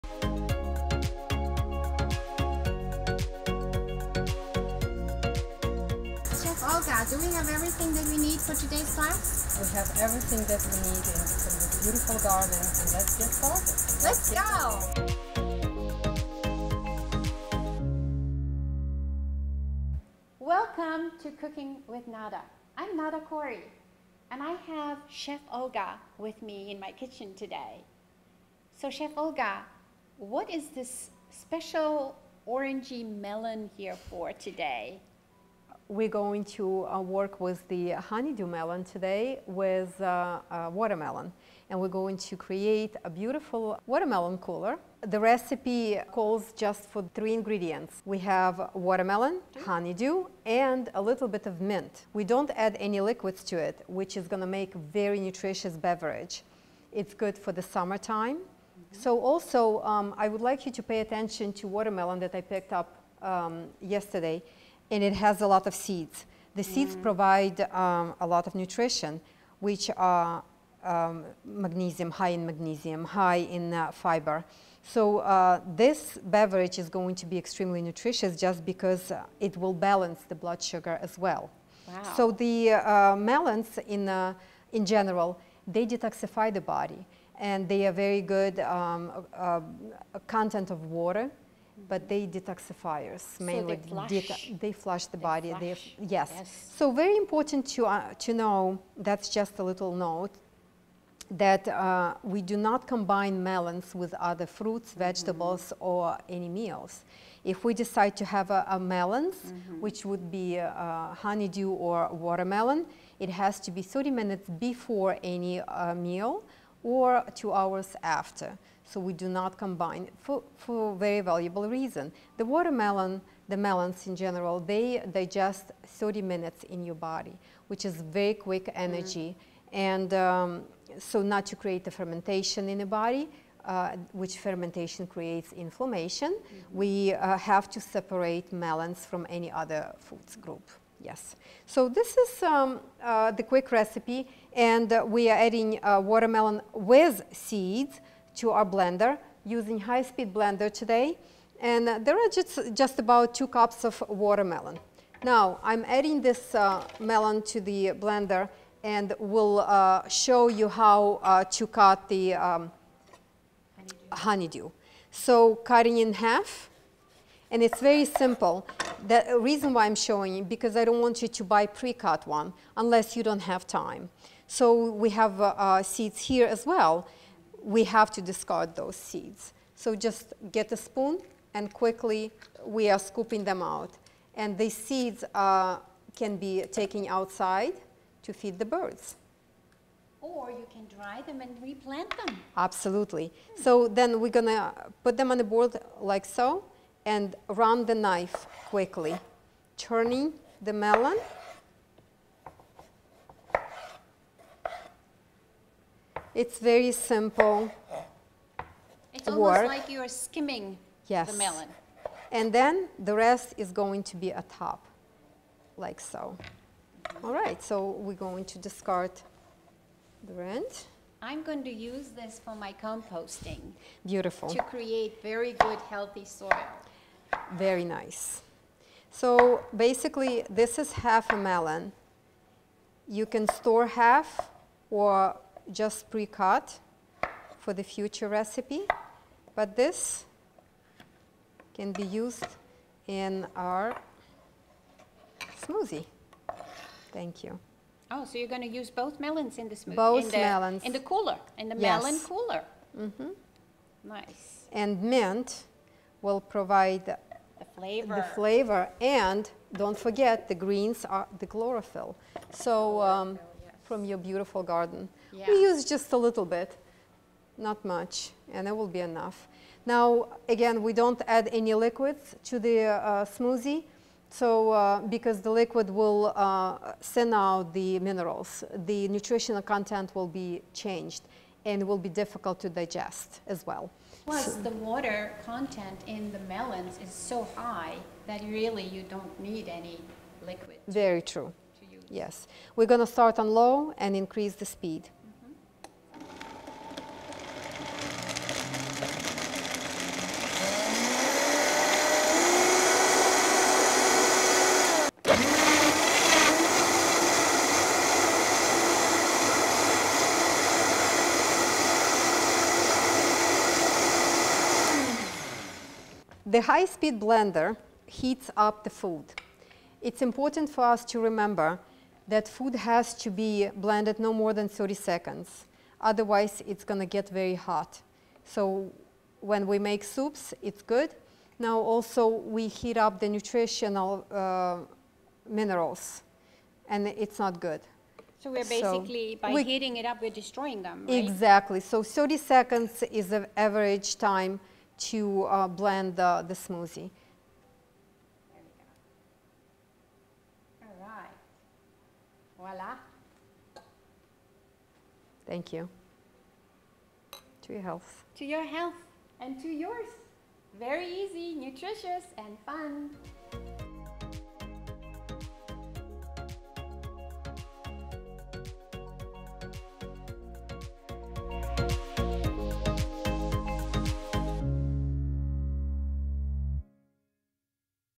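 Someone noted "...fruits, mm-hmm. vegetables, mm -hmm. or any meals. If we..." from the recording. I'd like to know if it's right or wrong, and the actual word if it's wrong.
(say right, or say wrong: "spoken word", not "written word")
right.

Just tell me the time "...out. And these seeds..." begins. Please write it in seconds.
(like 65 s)
183 s.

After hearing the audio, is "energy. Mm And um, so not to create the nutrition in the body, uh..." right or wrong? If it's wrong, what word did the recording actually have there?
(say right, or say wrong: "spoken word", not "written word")
wrong: "fermentation", not "nutrition".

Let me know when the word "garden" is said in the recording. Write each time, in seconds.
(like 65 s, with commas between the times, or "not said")
12 s, 264 s.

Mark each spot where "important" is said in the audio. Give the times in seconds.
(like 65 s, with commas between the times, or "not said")
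97 s, 320 s.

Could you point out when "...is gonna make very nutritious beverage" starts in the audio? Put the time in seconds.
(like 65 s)
54 s.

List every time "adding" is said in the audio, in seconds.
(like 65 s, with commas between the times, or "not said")
145 s, 155 s.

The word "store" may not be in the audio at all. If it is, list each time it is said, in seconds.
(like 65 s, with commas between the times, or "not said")
233 s.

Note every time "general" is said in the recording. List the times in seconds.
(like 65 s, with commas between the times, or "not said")
84 s, 124 s.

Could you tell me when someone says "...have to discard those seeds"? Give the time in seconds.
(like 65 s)
177 s.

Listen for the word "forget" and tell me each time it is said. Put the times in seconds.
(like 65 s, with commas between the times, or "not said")
259 s.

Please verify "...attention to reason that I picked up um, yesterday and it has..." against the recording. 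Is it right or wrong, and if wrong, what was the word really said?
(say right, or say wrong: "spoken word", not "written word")
wrong: "watermelon", not "reason".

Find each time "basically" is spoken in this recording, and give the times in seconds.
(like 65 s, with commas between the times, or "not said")
229 s, 338 s.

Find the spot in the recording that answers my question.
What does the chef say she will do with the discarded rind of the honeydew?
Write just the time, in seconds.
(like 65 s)
222 s.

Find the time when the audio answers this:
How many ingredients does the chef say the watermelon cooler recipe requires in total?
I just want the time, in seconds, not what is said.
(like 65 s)
47 s.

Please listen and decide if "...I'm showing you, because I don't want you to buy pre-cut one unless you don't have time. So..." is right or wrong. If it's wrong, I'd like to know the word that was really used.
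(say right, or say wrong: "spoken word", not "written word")
right.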